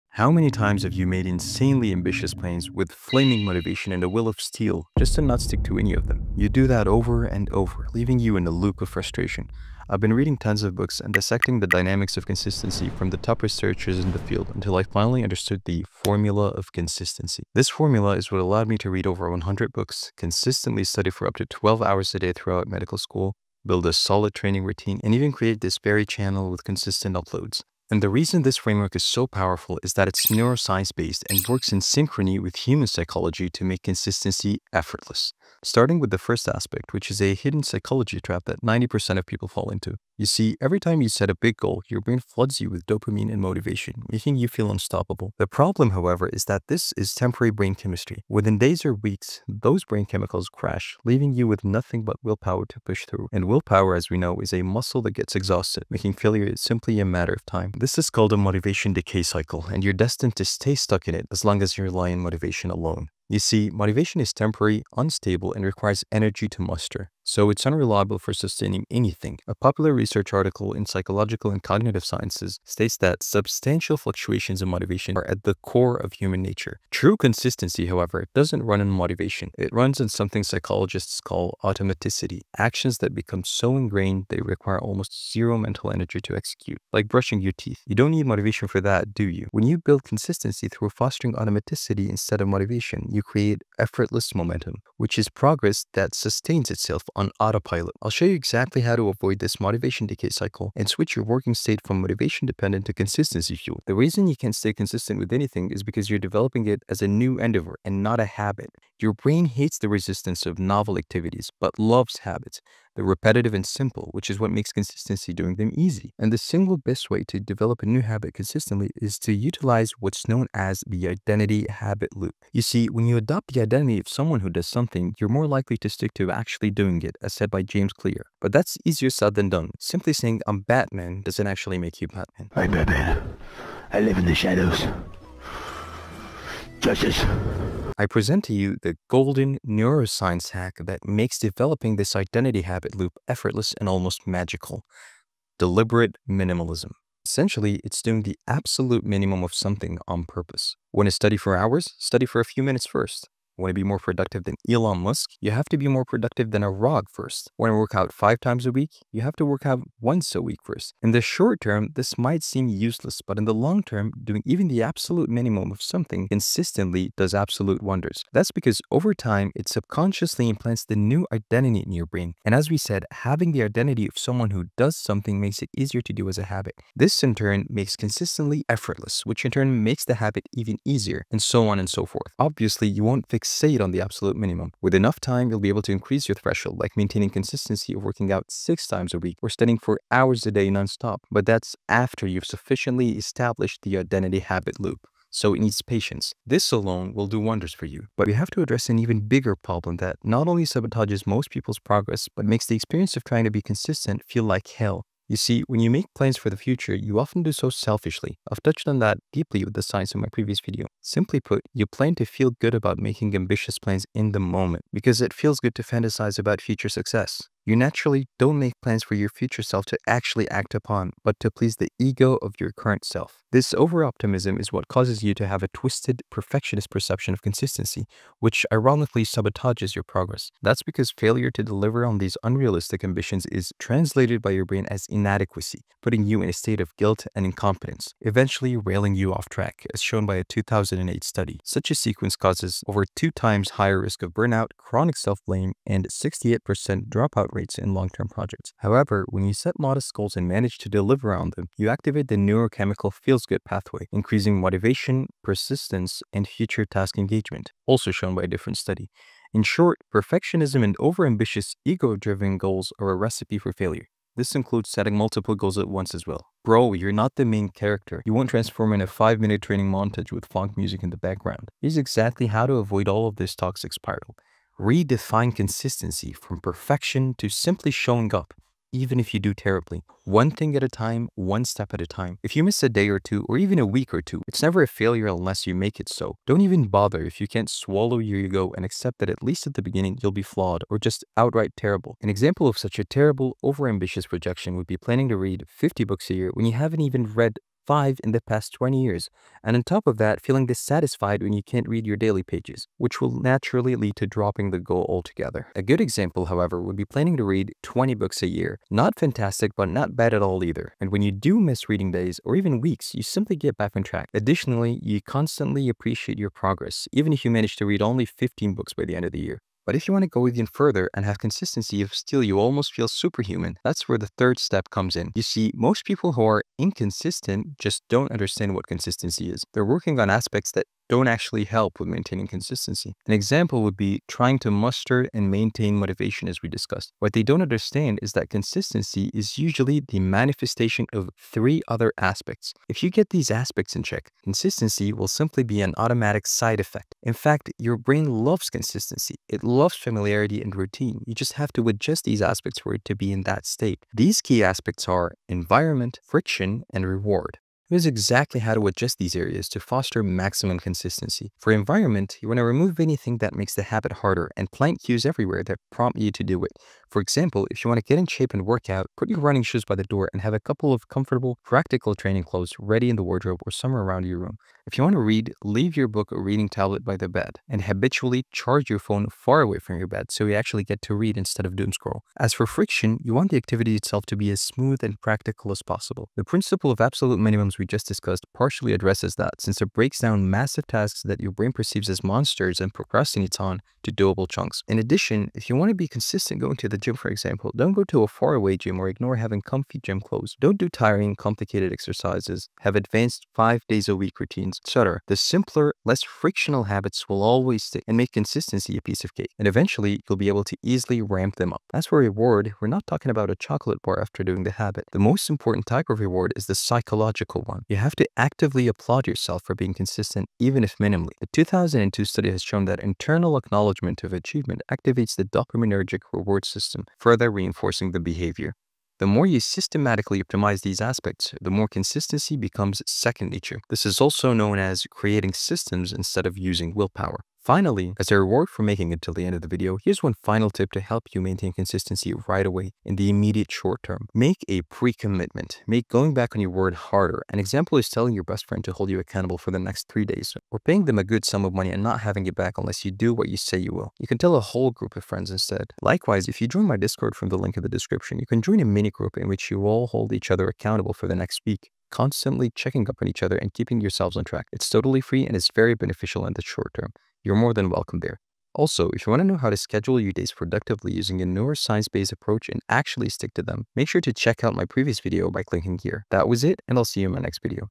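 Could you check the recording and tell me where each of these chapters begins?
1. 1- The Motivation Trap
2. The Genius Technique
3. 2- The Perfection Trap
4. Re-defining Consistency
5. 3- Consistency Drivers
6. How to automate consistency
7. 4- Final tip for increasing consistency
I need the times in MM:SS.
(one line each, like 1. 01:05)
1. 00:35
2. 01:43
3. 03:17
4. 04:34
5. 05:19
6. 05:57
7. 07:17.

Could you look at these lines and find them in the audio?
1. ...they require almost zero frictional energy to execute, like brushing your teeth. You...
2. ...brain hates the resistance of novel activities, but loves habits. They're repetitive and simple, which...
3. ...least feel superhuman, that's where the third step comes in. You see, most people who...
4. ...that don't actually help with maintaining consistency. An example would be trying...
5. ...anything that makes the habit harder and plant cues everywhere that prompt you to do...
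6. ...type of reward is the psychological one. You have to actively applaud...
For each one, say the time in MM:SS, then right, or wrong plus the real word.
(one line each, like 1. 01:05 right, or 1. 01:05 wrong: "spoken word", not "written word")
1. 01:24 wrong: "mental", not "frictional"
2. 01:49 right
3. 05:22 wrong: "almost", not "least"
4. 05:30 right
5. 06:03 right
6. 06:55 right.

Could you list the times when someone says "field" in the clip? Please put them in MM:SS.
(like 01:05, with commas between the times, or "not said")
00:14.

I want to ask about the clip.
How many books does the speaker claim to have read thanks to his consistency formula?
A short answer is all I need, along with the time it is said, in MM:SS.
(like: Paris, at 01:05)
over 100, at 00:19.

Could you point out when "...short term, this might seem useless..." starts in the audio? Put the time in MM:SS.
02:41.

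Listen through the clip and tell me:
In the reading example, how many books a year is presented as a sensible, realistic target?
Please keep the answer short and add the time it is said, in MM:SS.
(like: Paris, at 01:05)
20, at 05:07.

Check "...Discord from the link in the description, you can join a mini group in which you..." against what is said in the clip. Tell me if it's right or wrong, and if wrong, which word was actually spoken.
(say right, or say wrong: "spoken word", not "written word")
right.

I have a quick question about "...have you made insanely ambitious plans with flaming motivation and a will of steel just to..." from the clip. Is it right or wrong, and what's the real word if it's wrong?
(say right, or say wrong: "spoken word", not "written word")
right.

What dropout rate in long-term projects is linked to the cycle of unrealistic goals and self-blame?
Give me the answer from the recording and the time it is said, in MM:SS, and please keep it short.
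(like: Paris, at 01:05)
68%, at 04:06.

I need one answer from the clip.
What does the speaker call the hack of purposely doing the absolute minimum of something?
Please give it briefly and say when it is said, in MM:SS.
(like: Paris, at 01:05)
Deliberate minimalism, at 02:25.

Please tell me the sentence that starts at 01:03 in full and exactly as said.
You see, motivation is temporary, unstable, and requires energy to muster so it's unreliable for sustaining anything.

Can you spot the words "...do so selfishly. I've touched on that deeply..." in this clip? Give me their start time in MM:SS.
03:27.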